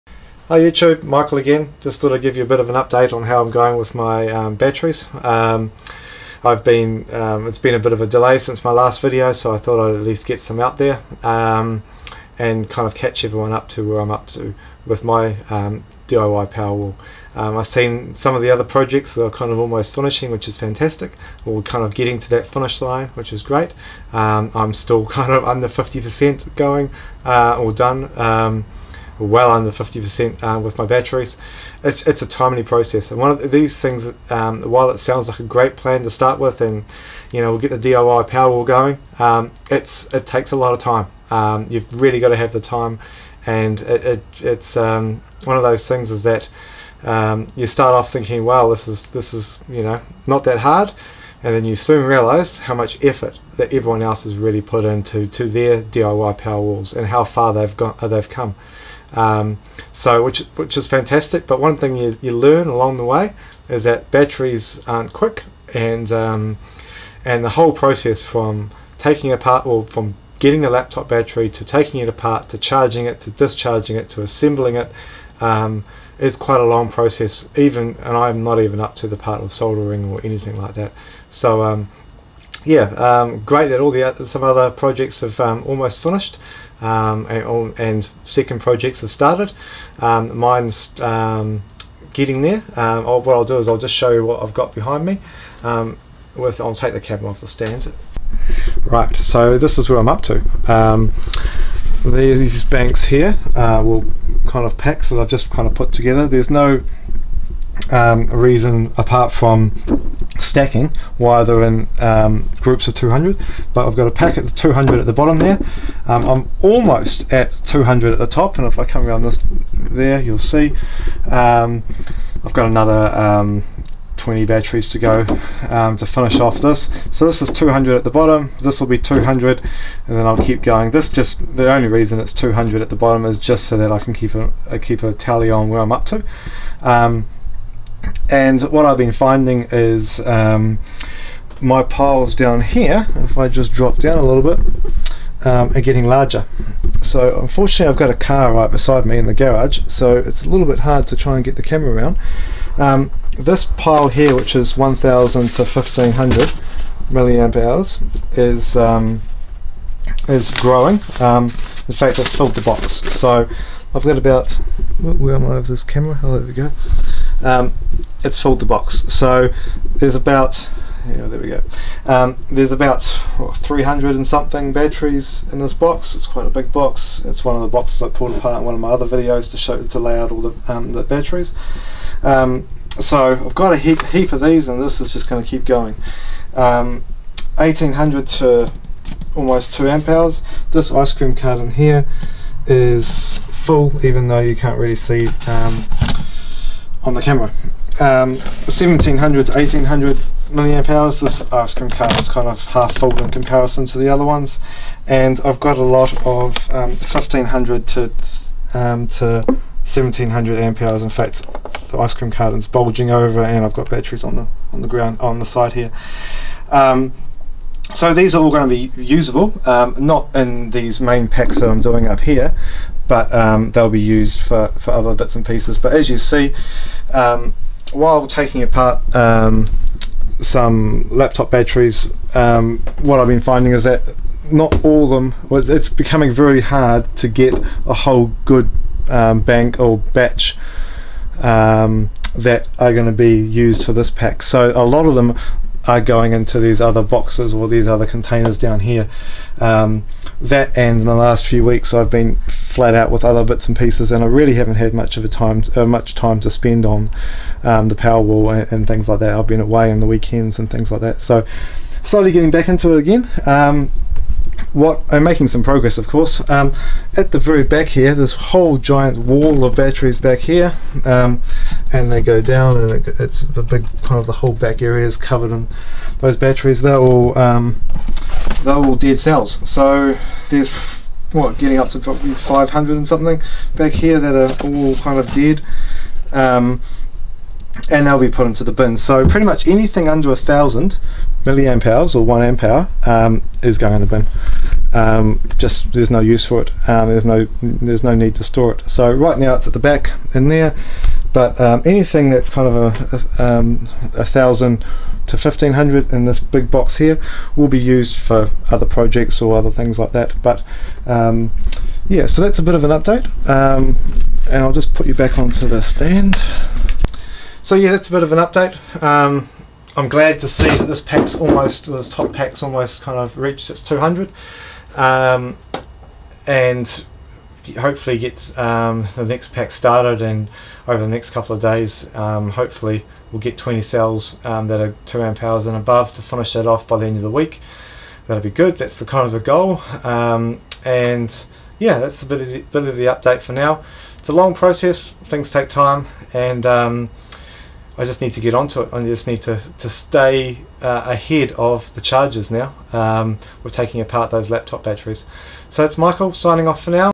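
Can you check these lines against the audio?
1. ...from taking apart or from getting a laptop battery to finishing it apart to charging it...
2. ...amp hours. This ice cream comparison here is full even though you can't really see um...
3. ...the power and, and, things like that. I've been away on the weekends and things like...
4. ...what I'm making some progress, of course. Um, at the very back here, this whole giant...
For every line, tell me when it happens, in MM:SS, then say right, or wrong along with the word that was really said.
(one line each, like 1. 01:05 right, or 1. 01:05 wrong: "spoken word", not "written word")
1. 01:08 wrong: "taking", not "finishing"
2. 03:09 wrong: "carton", not "comparison"
3. 04:17 right
4. 04:24 right.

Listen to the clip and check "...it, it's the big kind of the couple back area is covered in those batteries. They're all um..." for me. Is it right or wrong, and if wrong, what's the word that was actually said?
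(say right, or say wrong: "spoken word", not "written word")
wrong: "whole", not "couple".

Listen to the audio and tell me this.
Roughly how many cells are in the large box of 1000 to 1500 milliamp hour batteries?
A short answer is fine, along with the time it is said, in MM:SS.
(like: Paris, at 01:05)
300 and something, at 02:53.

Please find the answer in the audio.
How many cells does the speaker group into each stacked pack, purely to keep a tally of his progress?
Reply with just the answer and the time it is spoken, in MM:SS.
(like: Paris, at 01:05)
200, at 01:52.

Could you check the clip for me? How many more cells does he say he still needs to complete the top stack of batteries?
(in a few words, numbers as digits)
20.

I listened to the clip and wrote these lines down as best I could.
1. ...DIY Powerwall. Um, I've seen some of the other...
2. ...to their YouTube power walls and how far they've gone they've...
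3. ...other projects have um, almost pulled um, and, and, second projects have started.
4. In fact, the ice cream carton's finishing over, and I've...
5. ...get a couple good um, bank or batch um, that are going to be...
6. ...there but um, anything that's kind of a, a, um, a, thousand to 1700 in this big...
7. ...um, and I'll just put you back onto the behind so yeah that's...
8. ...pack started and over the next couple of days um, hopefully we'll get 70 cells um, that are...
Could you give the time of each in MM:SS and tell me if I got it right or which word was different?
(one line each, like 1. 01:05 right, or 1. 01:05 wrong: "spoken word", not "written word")
1. 00:16 right
2. 00:55 wrong: "DIY", not "YouTube"
3. 01:24 wrong: "finished", not "pulled"
4. 03:31 wrong: "bulging", not "finishing"
5. 03:57 wrong: "whole", not "couple"
6. 05:00 wrong: "1500", not "1700"
7. 05:13 wrong: "stand", not "behind"
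8. 05:29 wrong: "20", not "70".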